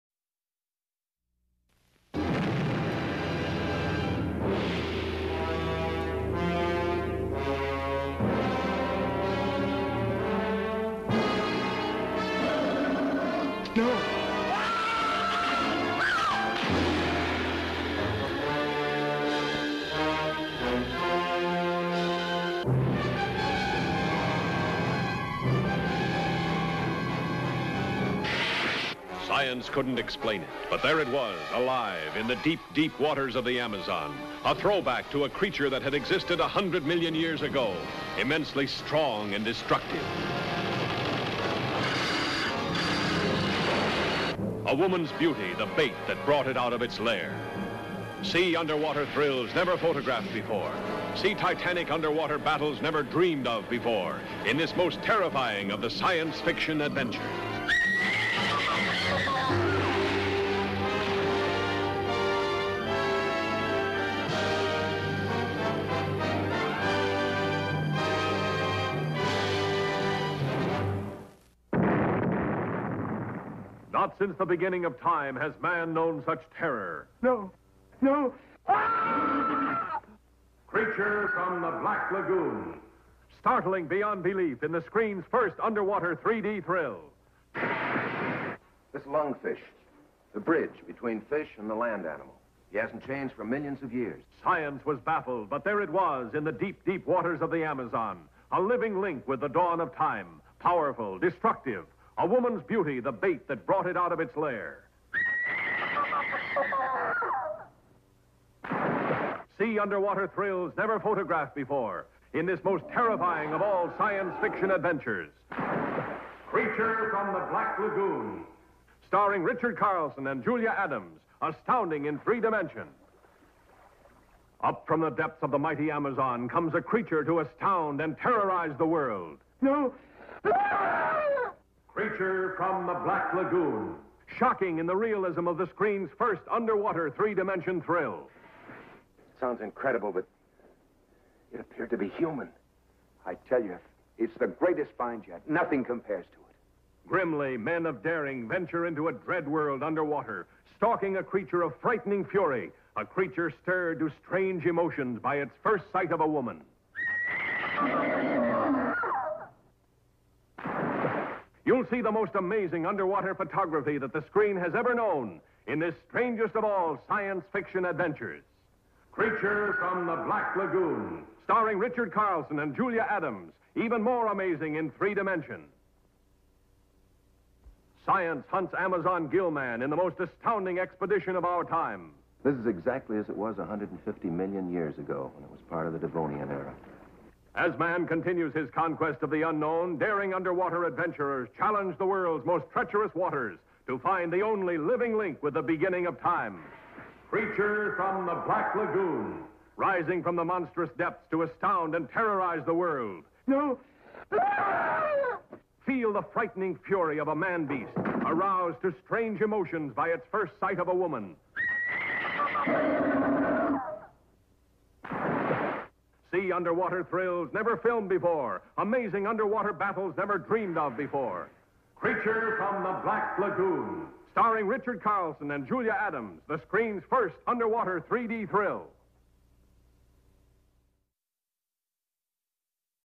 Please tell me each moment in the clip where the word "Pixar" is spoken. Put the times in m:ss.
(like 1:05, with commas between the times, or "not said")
not said.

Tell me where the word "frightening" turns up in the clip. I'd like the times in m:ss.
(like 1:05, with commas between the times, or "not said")
2:31, 3:26.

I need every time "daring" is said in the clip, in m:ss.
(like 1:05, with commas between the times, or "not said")
2:28, 3:09.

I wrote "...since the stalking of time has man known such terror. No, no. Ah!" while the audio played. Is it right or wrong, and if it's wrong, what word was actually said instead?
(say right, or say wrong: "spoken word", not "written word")
wrong: "beginning", not "stalking".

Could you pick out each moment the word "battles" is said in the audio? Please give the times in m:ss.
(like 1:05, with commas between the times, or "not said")
0:52, 3:39.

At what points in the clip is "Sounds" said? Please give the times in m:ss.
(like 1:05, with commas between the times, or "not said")
2:19.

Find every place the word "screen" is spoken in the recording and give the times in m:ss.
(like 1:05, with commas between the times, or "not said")
1:24, 2:15, 2:44, 3:46.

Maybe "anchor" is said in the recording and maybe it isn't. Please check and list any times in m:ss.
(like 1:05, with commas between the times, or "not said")
not said.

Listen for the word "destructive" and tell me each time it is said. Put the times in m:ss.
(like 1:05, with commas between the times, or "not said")
0:39, 1:41.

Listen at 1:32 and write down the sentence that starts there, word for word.
He hasn't changed for millions of years.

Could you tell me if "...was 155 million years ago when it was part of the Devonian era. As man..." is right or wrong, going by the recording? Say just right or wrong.
wrong.